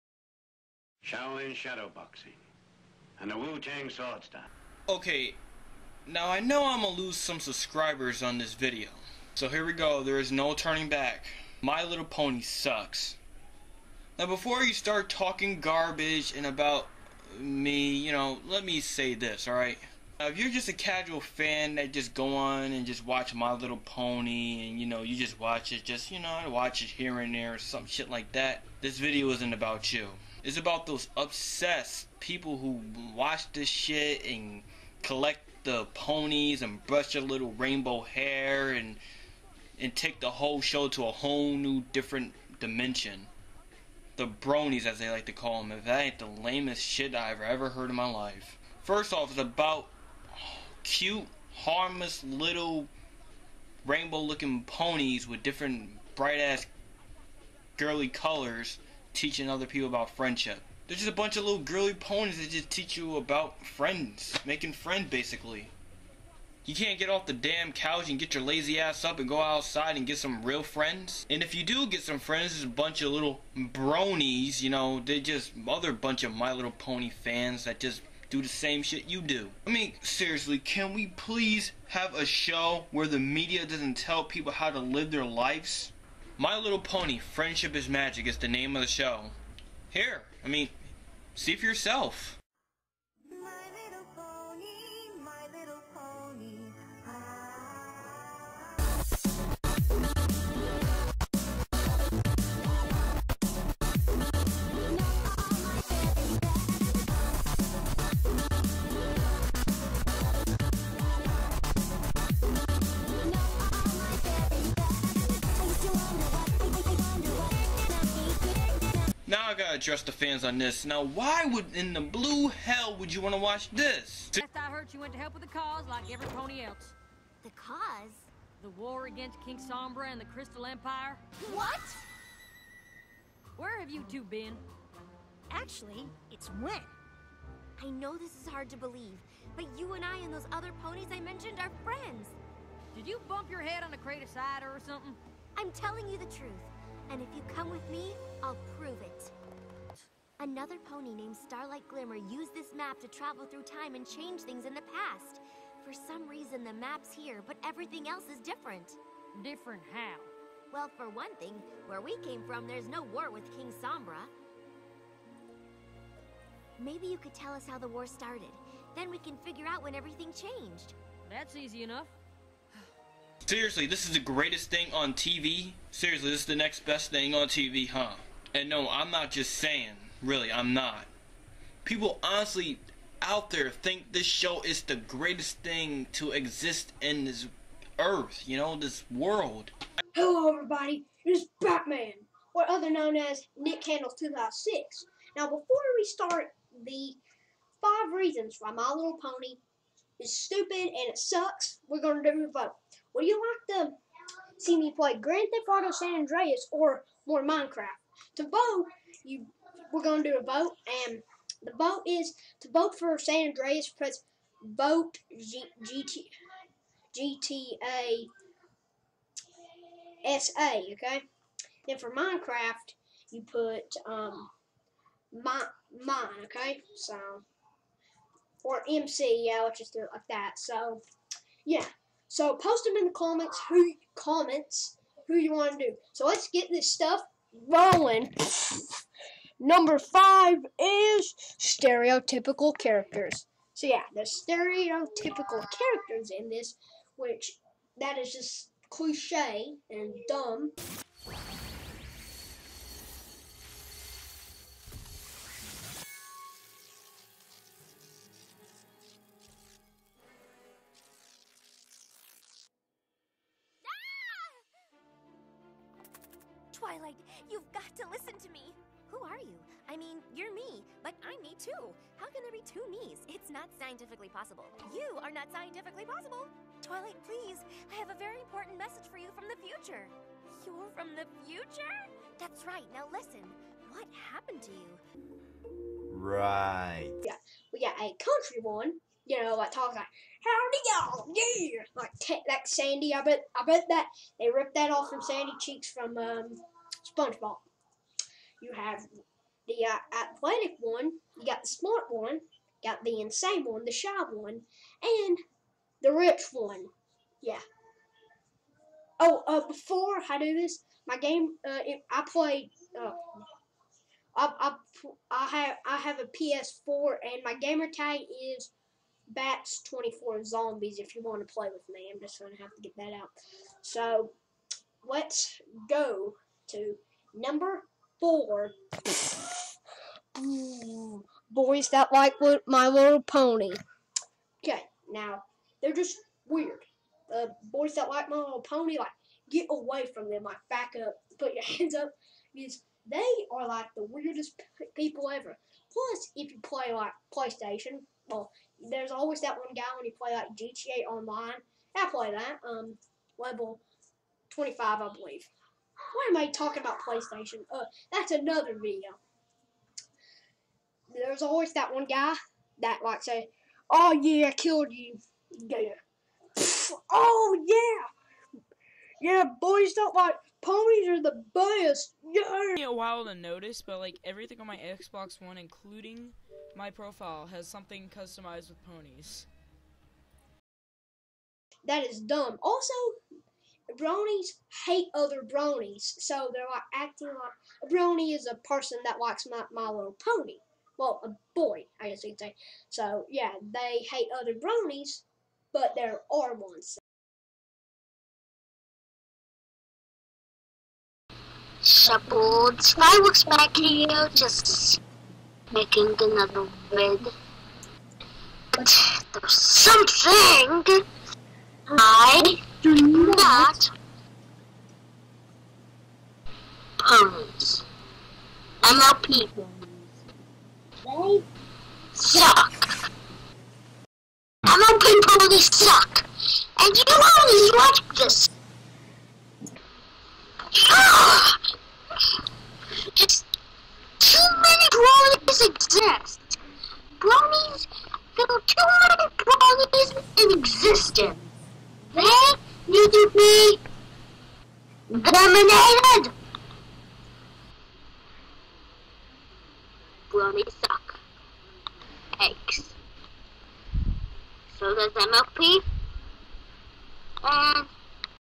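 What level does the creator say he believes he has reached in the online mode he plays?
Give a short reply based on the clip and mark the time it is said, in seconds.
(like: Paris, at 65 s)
25, at 353 s.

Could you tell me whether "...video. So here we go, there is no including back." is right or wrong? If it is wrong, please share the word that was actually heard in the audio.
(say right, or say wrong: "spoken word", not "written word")
wrong: "turning", not "including".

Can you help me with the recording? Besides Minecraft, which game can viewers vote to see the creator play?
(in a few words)
Grand Theft Auto San Andreas.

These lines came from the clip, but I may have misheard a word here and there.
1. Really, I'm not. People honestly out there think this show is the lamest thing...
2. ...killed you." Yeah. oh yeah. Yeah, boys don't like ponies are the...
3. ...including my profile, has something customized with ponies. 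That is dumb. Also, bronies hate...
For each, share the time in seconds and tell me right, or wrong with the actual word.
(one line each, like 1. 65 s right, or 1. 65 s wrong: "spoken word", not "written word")
1. 180 s wrong: "greatest", not "lamest"
2. 364 s right
3. 375 s right.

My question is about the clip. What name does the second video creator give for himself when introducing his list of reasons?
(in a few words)
Nick Candles 2006.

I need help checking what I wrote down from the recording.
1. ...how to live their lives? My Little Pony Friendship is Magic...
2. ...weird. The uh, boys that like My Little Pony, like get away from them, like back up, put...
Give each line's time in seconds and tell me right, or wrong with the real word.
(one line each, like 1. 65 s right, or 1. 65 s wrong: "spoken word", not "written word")
1. 84 s right
2. 336 s right.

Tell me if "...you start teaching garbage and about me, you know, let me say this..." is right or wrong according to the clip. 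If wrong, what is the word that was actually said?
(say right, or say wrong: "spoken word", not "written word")
wrong: "talking", not "teaching".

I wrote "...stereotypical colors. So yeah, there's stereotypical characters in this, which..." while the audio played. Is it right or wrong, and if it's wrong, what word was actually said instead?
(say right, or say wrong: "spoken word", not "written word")
wrong: "characters", not "colors".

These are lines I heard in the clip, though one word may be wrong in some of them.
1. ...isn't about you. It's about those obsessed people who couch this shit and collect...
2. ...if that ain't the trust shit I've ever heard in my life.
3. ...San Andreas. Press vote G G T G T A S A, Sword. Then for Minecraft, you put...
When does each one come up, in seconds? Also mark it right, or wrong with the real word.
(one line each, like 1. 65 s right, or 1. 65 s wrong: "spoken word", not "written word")
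1. 29 s wrong: "watch", not "couch"
2. 45 s wrong: "lamest", not "trust"
3. 213 s wrong: "Okay", not "Sword".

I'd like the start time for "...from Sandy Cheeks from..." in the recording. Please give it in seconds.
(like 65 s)
295 s.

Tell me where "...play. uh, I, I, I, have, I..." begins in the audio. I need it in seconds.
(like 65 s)
312 s.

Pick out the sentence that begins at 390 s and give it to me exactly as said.
Well, a boy, I guess you would say.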